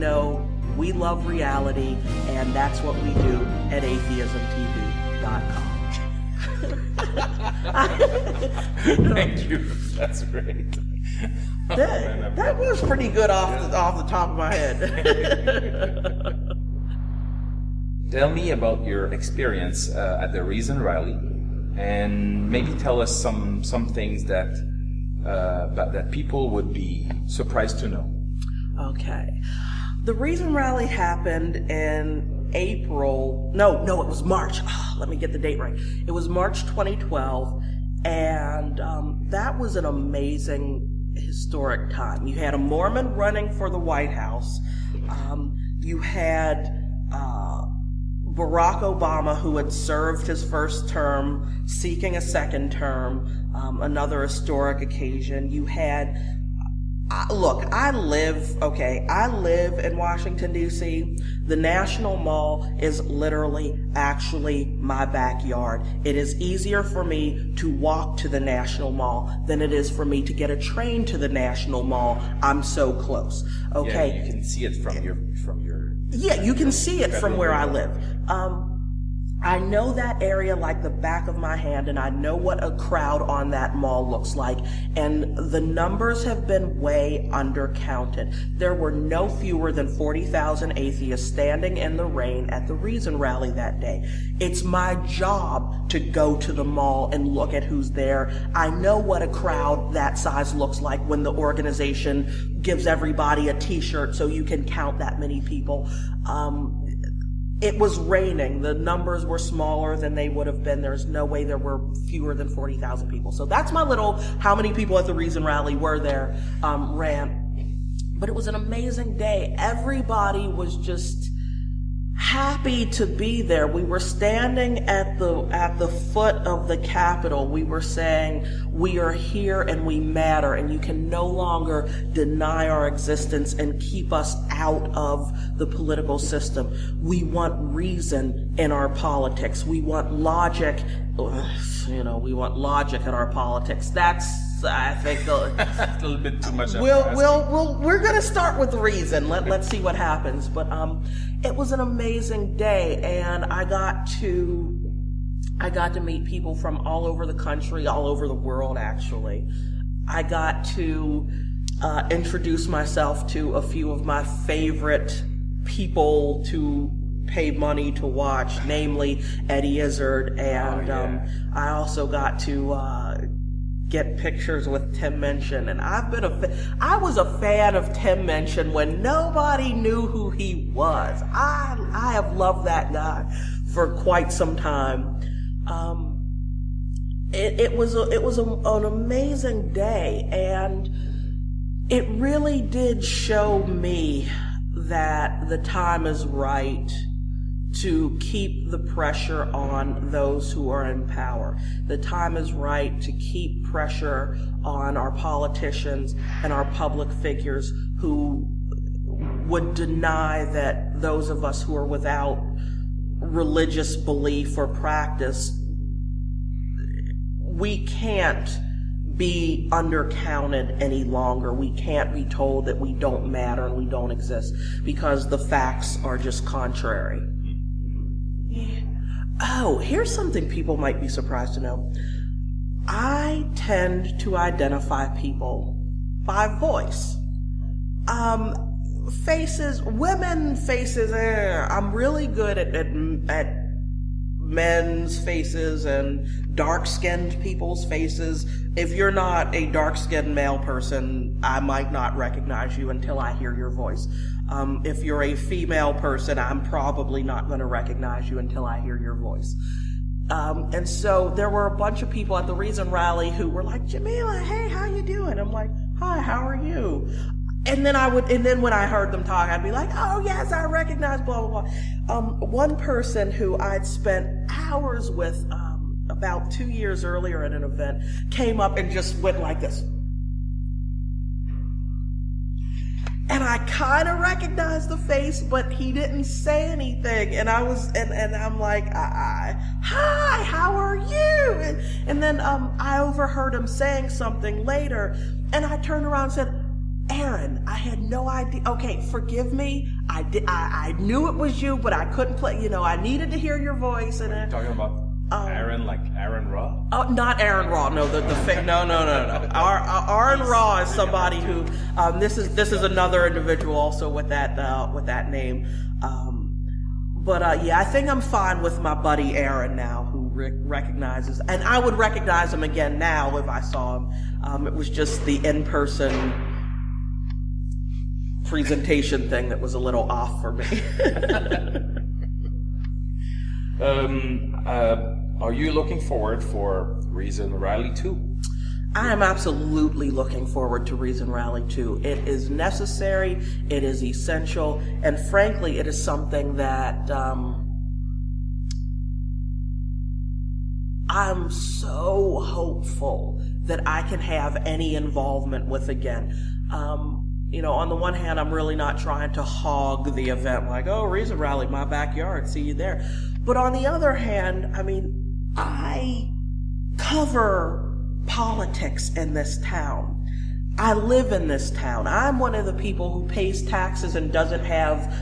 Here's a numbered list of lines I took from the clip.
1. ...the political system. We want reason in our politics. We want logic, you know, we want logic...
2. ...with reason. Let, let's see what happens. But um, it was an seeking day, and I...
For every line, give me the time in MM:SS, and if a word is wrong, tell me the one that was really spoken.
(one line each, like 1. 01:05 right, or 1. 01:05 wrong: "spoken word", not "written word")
1. 02:15 right
2. 02:28 wrong: "amazing", not "seeking".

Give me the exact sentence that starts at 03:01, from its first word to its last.
I I have loved that guy for quite some time.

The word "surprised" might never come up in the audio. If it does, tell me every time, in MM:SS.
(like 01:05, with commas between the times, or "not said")
00:27, 03:51.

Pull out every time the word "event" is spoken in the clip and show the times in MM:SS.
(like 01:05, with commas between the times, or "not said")
04:37, 06:00.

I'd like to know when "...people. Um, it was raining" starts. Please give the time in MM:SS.
01:45.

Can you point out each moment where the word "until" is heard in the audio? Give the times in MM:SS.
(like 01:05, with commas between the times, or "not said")
04:12, 04:18.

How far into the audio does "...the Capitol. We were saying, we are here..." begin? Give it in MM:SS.
02:06.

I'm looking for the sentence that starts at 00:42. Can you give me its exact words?
You had a Mormon running for the White House.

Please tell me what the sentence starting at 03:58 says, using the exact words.
Um, faces, women faces, eh, I'm really good at, at, at men's faces and dark skinned people's faces.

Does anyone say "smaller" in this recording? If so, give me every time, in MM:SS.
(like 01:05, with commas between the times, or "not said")
01:49.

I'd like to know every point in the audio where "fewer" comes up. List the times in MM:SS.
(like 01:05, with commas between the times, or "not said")
01:29, 01:52.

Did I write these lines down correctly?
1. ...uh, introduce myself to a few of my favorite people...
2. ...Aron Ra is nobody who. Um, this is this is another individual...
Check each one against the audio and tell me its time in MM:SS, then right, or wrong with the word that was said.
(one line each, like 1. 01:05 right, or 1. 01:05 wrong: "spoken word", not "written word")
1. 02:41 right
2. 05:10 wrong: "somebody", not "nobody".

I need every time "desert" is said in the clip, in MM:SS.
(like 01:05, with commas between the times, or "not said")
not said.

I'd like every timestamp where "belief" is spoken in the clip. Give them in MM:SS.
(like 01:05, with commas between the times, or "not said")
03:33.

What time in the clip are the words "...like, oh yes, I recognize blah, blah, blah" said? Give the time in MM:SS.
04:29.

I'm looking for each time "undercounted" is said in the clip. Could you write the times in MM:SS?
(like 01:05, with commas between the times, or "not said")
01:27, 03:39.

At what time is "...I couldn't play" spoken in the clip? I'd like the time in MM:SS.
05:01.